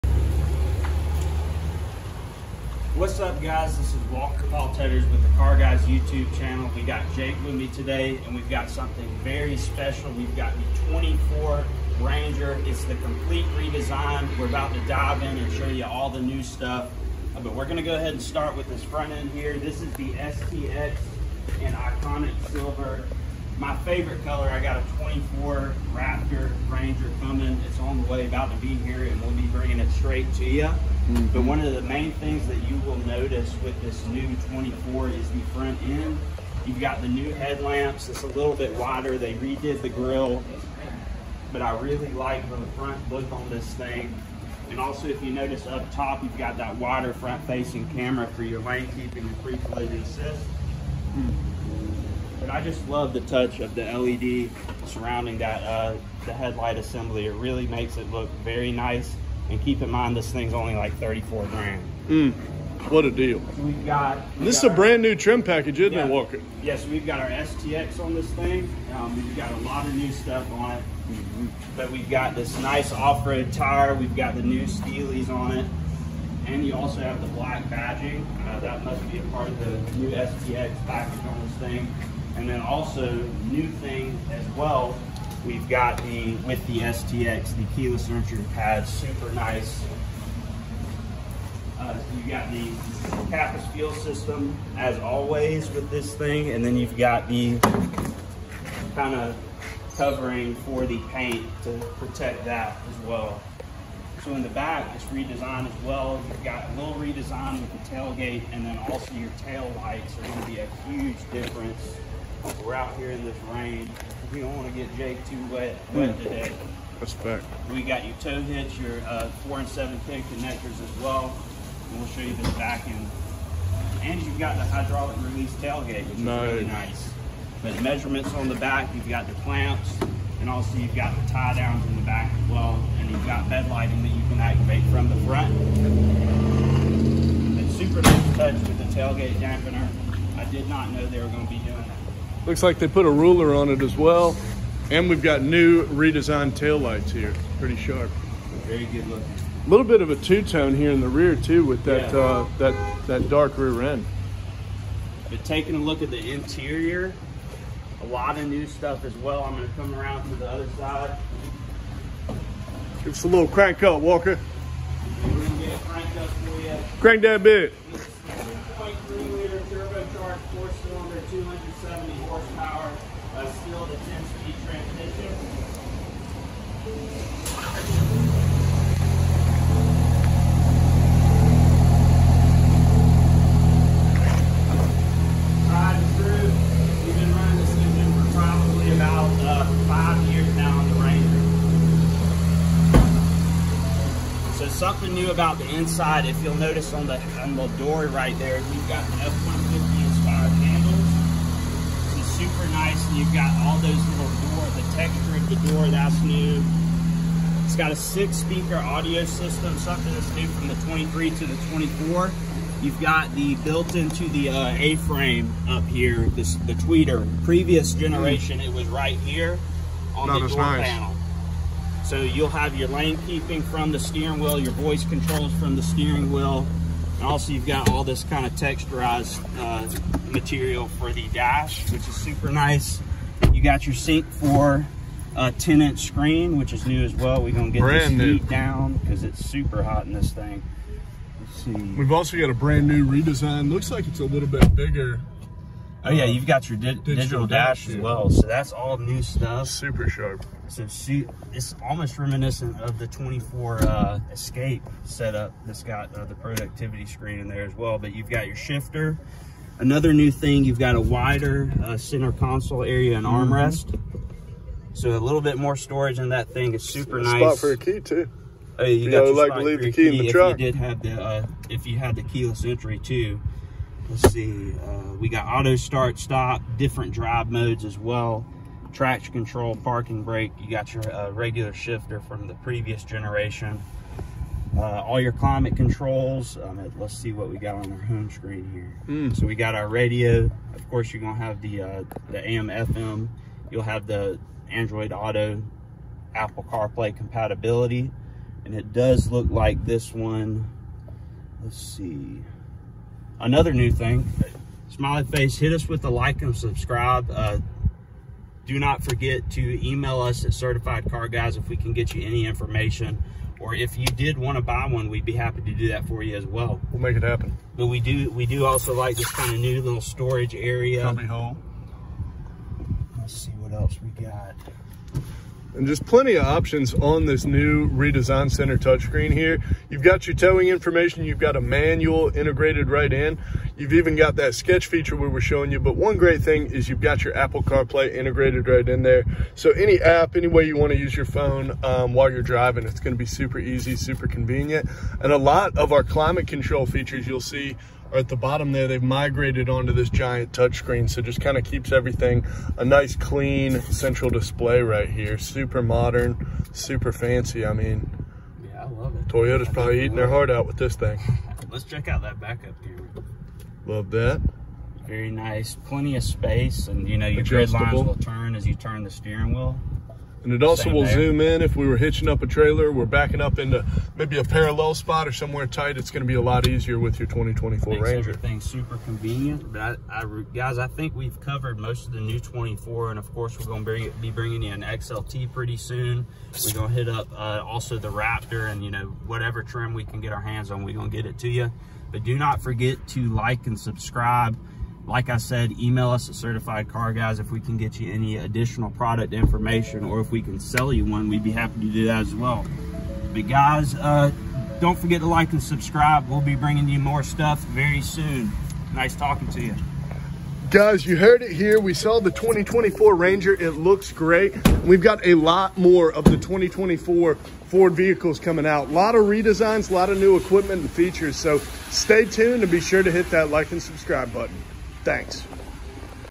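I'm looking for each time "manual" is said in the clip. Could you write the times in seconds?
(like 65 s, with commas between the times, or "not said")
331 s.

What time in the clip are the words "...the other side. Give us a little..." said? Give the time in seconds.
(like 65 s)
160 s.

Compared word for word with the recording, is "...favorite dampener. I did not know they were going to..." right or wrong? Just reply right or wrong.
wrong.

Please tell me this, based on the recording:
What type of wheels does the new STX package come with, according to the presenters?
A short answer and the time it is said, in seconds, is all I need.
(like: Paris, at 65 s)
Steelies, at 74 s.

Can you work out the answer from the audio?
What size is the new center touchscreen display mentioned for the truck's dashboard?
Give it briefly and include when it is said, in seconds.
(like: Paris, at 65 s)
10 inch, at 235 s.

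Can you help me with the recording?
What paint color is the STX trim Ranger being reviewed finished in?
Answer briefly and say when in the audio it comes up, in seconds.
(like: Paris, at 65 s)
Iconic Silver, at 21 s.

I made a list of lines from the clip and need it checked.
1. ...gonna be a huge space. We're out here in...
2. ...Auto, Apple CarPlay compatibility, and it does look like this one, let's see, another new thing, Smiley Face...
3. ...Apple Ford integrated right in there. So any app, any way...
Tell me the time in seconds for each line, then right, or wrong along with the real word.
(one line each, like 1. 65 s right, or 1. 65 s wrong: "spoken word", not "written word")
1. 110 s wrong: "difference", not "space"
2. 295 s right
3. 337 s wrong: "CarPlay", not "Ford".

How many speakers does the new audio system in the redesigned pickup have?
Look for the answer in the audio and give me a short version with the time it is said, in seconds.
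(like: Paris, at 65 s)
six, at 207 s.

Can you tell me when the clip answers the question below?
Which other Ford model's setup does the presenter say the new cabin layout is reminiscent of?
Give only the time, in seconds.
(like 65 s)
254 s.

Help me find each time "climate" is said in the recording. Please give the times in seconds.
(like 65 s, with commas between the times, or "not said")
285 s, 346 s.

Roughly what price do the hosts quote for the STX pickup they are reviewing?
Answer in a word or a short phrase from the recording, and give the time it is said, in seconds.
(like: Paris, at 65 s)
34 grand, at 60 s.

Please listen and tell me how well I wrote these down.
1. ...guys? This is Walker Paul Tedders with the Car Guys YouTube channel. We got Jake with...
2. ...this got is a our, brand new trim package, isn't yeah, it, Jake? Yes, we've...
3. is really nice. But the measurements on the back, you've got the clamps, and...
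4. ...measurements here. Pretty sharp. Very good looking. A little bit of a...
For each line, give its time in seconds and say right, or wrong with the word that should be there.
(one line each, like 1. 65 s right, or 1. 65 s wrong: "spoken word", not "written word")
1. 3 s right
2. 64 s wrong: "Walker", not "Jake"
3. 126 s right
4. 146 s wrong: "taillights", not "measurements".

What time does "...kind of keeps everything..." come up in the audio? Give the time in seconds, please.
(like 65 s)
351 s.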